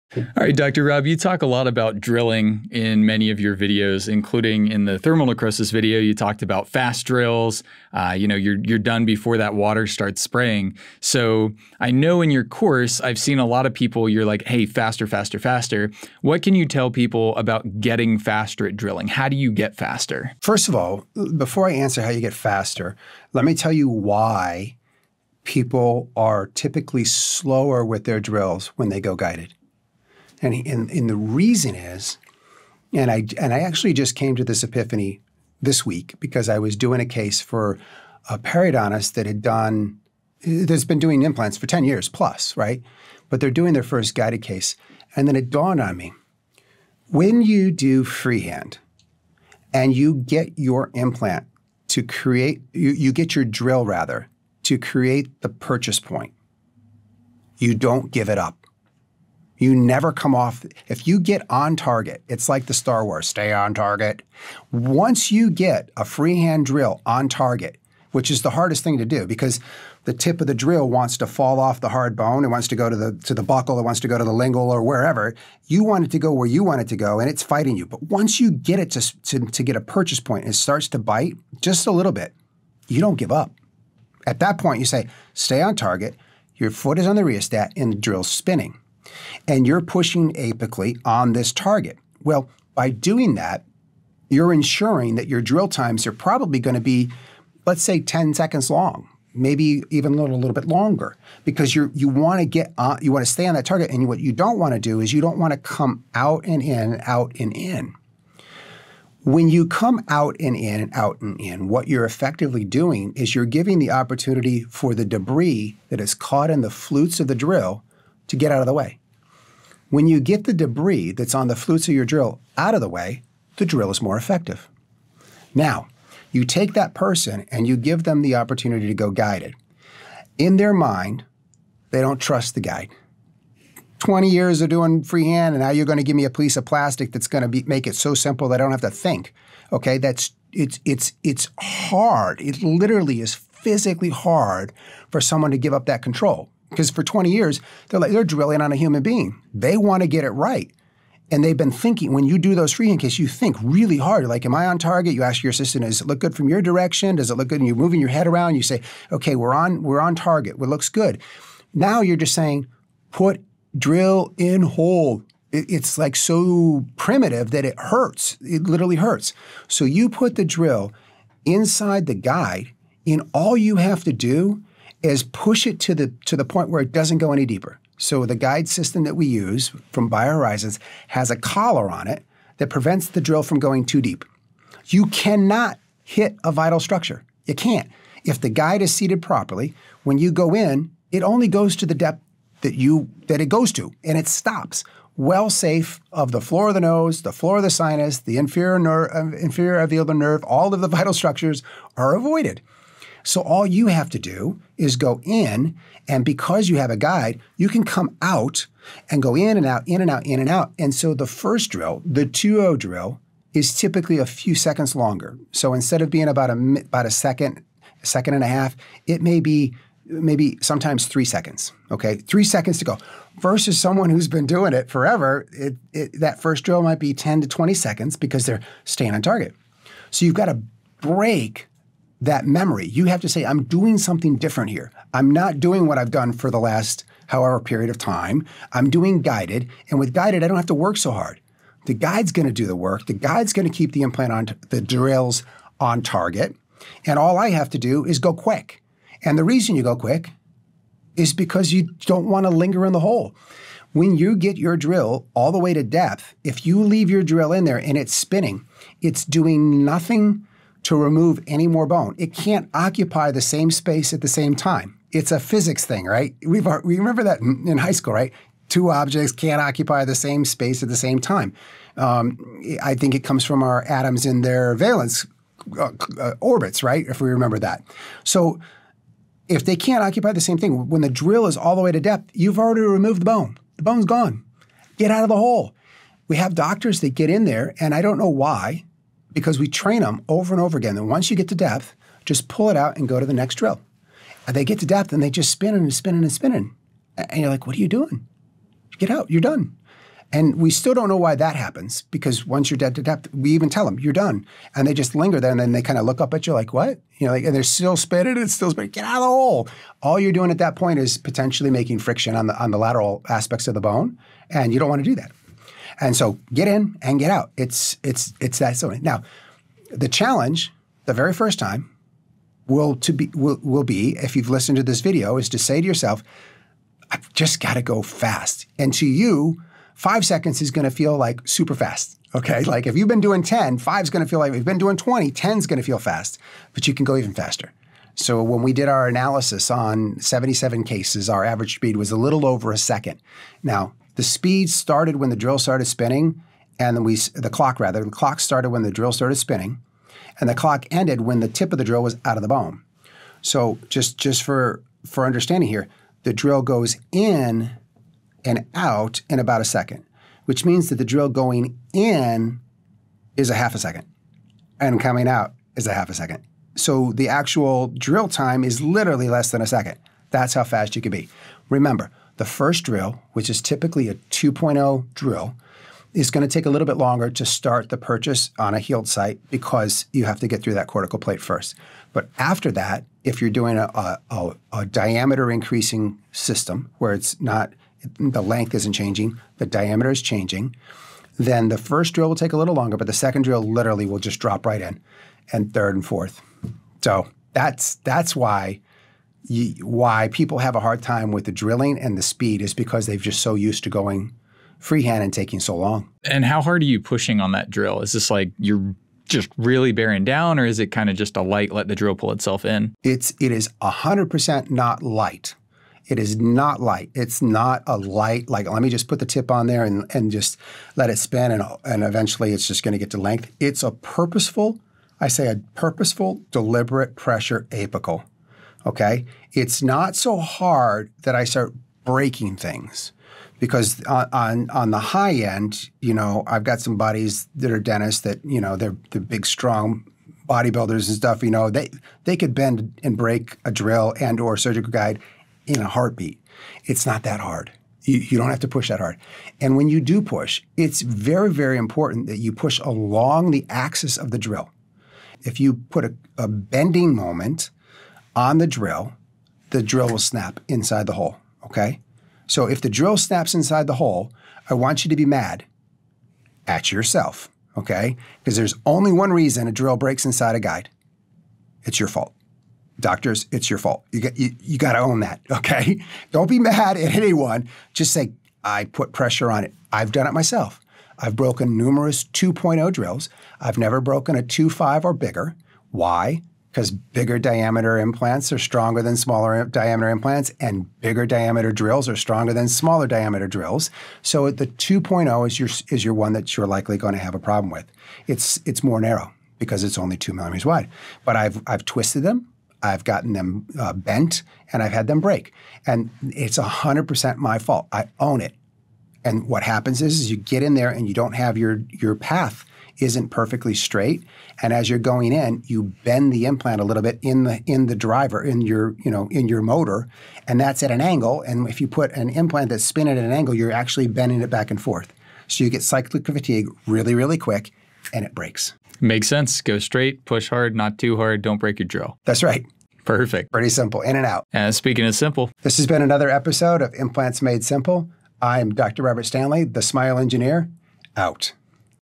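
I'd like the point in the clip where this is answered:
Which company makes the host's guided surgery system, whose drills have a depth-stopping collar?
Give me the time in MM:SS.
03:00.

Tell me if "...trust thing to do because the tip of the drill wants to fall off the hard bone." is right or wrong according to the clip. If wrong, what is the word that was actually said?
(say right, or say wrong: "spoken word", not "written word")
wrong: "hardest", not "trust".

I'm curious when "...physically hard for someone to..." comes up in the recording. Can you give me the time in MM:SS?
02:23.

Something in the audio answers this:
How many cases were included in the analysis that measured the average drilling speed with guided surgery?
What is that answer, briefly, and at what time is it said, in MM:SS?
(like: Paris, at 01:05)
77, at 05:40.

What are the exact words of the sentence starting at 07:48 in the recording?
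Because there's only one reason a drill breaks inside a guide.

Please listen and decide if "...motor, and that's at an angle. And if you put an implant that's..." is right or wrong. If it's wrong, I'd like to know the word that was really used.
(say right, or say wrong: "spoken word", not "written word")
right.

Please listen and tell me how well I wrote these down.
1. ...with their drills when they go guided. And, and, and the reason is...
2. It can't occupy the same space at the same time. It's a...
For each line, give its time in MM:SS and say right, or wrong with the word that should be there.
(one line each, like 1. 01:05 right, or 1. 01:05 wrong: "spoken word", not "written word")
1. 00:27 right
2. 04:22 right.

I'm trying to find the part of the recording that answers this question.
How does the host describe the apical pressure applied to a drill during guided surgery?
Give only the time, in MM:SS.
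07:05.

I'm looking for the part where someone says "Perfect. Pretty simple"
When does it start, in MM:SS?
08:53.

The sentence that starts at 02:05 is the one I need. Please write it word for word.
Now, you take that person and you give them the opportunity to go guided.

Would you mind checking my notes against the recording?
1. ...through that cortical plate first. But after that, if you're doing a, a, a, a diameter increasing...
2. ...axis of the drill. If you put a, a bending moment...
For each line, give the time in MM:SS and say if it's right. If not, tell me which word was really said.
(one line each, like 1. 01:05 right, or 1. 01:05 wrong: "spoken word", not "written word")
1. 06:20 right
2. 07:33 right.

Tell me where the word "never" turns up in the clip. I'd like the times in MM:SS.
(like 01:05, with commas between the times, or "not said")
00:59, 08:03.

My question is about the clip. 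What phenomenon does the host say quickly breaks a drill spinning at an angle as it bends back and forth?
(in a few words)
cyclic fatigue.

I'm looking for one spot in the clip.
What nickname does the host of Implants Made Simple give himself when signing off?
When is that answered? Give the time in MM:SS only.
08:59.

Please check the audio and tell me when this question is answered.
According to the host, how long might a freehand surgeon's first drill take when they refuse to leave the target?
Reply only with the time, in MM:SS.
03:47.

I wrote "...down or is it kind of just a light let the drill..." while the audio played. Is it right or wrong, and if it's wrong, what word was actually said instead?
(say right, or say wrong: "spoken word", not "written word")
right.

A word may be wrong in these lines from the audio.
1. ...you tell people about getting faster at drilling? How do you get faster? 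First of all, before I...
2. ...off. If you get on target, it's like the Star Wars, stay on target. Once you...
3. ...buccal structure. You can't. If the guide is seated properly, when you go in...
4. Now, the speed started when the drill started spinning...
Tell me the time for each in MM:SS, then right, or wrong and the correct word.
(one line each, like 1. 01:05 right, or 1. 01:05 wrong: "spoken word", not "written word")
1. 00:16 right
2. 01:00 right
3. 03:06 wrong: "vital", not "buccal"
4. 05:43 right.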